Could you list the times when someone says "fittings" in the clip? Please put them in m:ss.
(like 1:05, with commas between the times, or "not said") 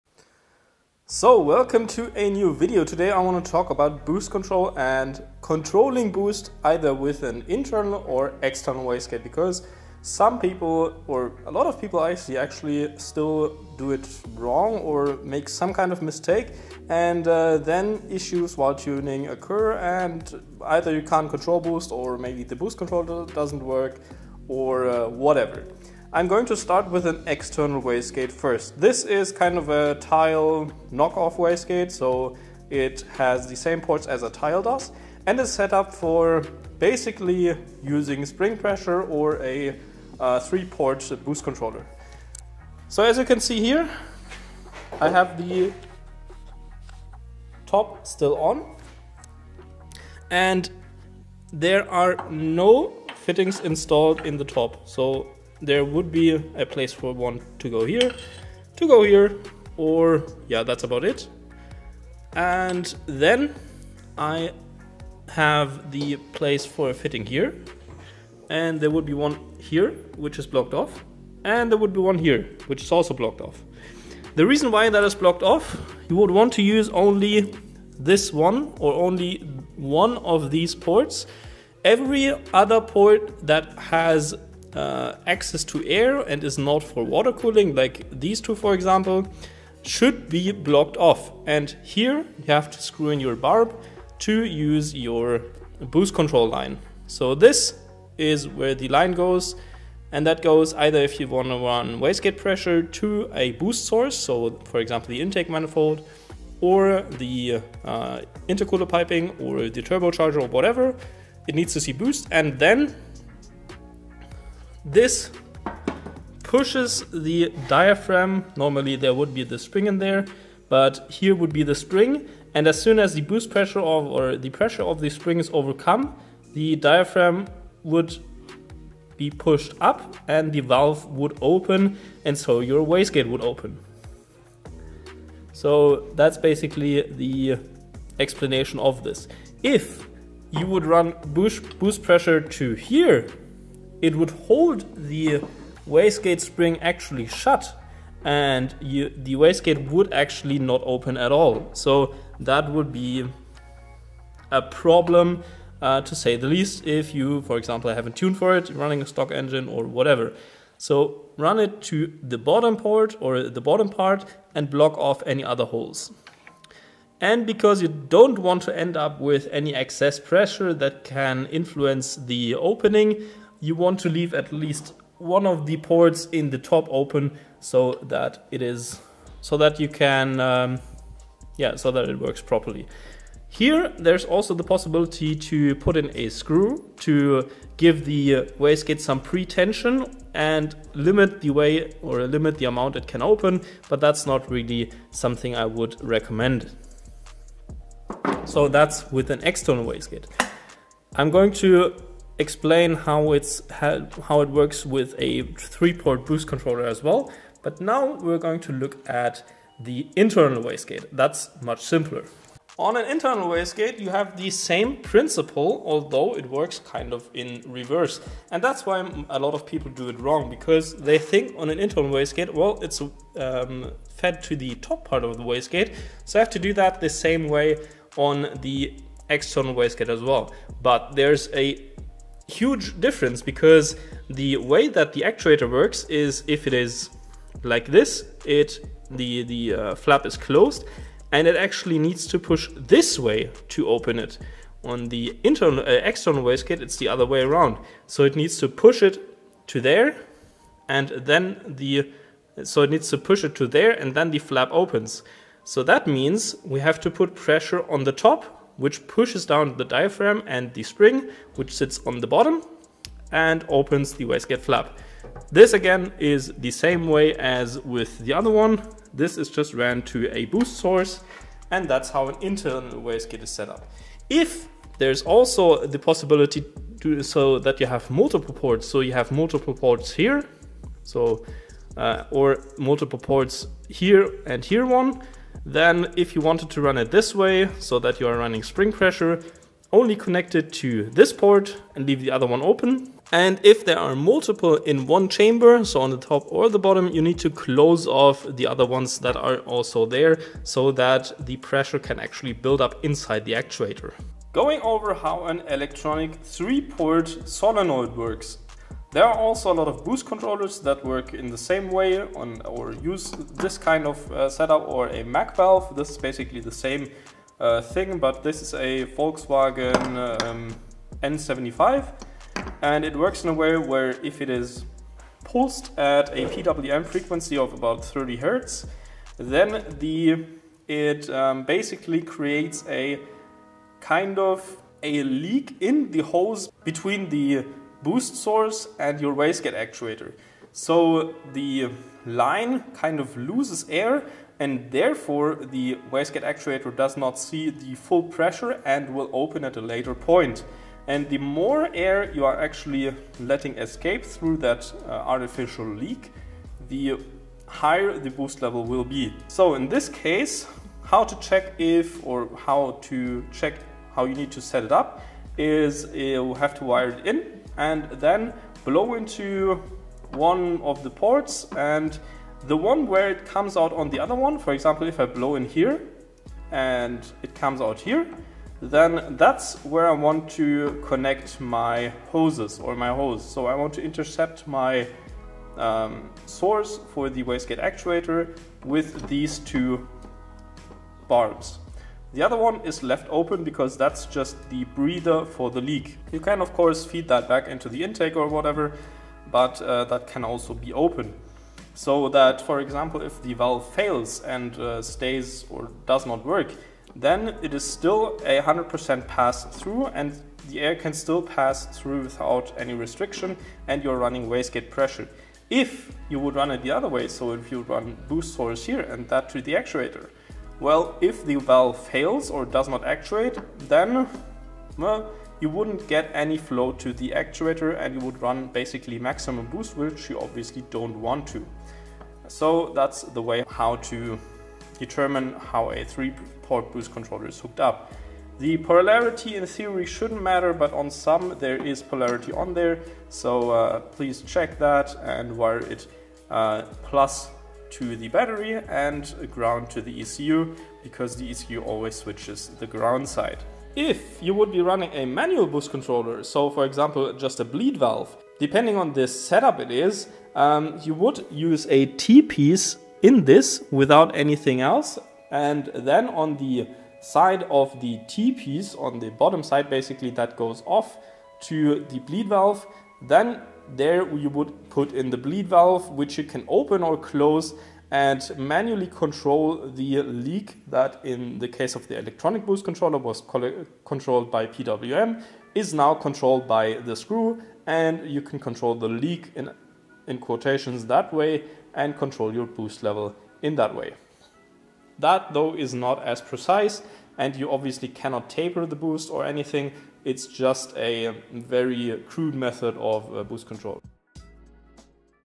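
0:53, 1:06.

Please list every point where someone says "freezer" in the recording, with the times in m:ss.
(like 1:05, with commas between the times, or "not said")
not said.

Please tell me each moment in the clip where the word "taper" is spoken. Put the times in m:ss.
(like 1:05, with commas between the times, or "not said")
8:18.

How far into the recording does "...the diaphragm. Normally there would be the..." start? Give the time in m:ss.
1:57.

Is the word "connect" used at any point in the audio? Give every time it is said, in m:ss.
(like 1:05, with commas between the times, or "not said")
4:50, 6:21.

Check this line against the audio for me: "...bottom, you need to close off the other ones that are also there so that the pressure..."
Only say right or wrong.
right.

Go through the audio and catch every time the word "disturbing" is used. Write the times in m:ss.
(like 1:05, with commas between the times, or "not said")
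not said.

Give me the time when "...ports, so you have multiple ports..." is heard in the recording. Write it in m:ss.
4:38.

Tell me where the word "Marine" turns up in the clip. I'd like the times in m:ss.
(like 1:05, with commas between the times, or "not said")
not said.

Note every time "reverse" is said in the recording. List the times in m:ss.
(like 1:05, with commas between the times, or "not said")
3:37.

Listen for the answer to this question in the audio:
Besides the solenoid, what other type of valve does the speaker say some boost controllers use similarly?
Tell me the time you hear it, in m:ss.
5:15.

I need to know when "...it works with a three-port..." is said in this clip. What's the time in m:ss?
3:24.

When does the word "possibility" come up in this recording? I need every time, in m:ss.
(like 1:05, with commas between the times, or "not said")
3:04, 4:35.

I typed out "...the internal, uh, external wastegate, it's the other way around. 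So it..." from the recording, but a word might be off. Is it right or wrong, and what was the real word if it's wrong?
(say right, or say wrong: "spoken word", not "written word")
right.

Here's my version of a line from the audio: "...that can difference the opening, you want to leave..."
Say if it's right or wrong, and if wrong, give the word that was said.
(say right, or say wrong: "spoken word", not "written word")
wrong: "influence", not "difference".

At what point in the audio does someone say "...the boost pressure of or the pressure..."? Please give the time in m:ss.
2:03.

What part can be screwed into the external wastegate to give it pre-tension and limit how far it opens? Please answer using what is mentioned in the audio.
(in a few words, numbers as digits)
A screw.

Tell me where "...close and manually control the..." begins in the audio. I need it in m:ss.
7:57.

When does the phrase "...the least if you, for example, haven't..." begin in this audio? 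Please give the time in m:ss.
2:36.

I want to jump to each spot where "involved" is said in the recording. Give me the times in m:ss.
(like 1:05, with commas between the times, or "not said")
not said.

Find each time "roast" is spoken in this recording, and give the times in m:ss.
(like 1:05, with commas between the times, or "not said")
not said.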